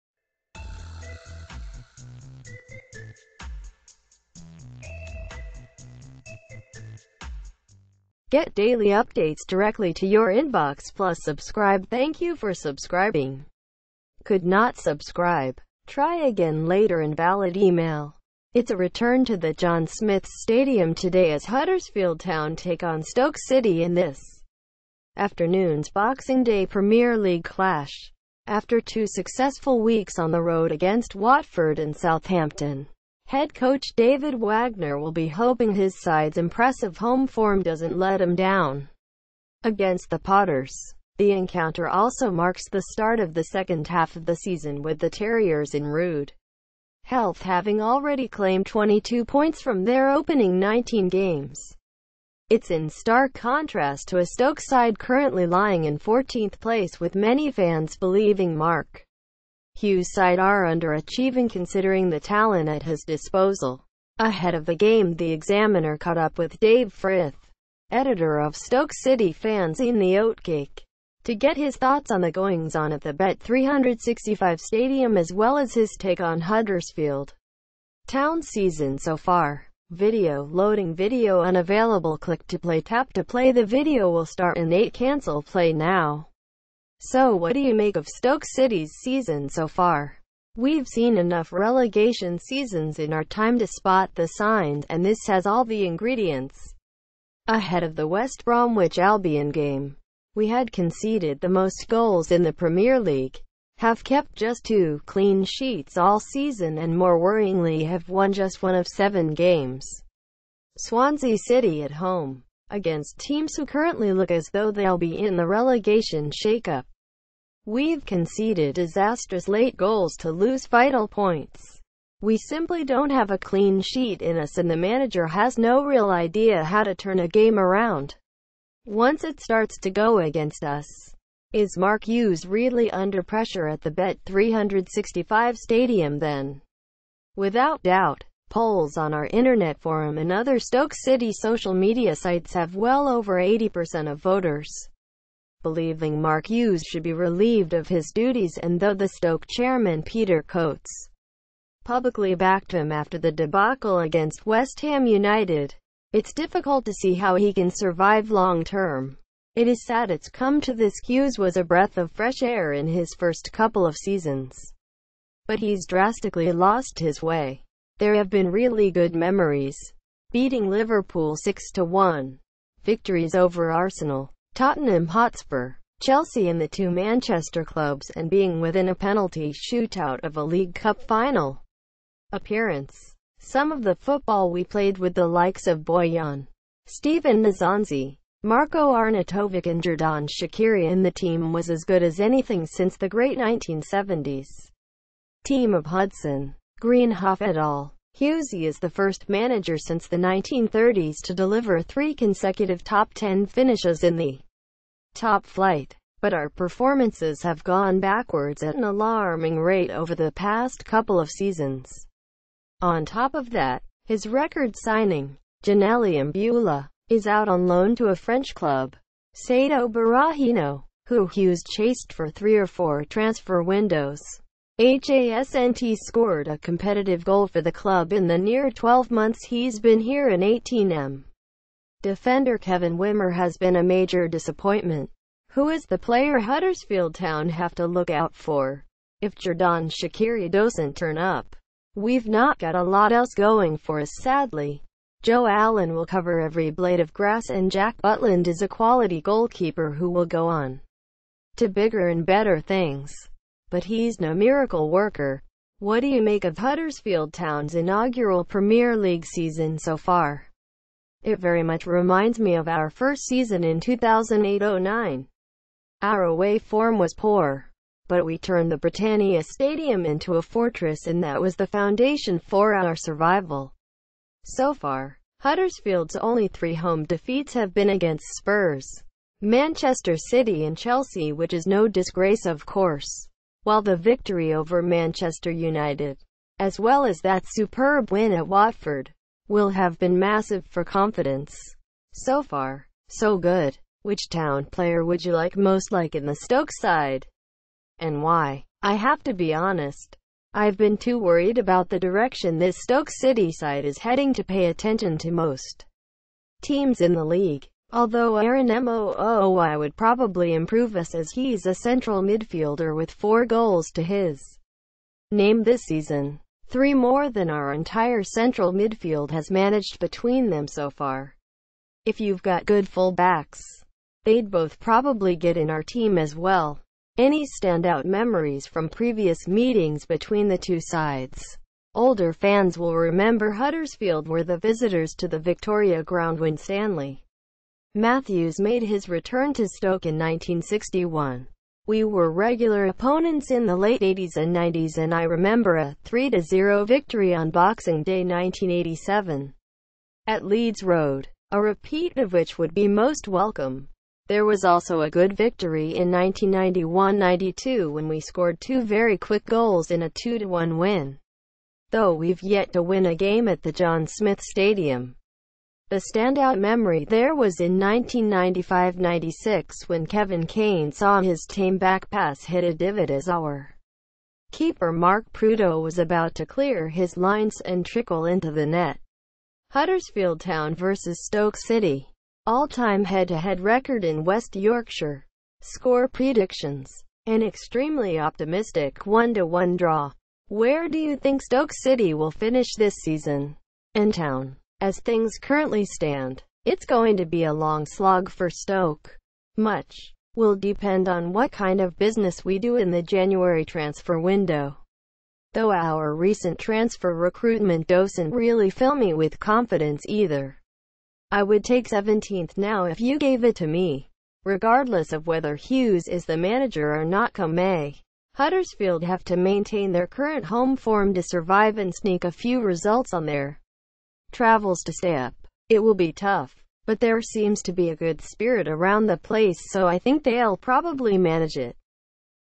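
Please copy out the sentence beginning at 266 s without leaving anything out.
Our away form was poor, but we turned the Britannia Stadium into a fortress and that was the foundation for our survival.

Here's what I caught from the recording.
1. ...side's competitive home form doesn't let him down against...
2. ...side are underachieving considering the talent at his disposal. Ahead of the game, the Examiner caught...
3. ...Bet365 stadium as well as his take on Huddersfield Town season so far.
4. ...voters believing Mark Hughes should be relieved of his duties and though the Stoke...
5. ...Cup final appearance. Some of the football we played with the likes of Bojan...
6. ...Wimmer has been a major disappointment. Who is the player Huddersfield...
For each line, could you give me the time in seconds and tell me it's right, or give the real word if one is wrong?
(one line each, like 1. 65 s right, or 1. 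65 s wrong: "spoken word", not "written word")
1. 35 s wrong: "impressive", not "competitive"
2. 60 s right
3. 73 s right
4. 144 s right
5. 180 s right
6. 232 s right.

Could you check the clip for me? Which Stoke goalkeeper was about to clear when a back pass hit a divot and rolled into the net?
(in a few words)
Mark Prudhoe.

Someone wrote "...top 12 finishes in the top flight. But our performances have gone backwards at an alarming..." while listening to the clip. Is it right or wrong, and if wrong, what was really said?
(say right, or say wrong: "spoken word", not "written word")
wrong: "10", not "12".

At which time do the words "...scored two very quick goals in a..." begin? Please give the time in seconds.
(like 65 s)
358 s.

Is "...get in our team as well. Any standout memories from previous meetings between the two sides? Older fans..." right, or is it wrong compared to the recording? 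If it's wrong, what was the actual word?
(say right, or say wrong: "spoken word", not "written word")
right.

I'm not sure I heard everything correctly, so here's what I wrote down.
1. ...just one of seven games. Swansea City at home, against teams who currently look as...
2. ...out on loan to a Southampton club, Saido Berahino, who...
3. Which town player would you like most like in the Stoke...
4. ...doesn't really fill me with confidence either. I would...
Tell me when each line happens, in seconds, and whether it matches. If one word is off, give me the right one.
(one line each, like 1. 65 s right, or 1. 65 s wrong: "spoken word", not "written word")
1. 108 s right
2. 217 s wrong: "French", not "Southampton"
3. 294 s right
4. 407 s right.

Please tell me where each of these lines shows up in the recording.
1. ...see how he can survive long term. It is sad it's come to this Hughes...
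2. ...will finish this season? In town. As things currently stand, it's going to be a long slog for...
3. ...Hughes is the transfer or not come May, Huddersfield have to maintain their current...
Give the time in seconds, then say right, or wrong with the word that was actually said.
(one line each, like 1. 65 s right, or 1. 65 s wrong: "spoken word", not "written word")
1. 156 s right
2. 392 s right
3. 415 s wrong: "manager", not "transfer".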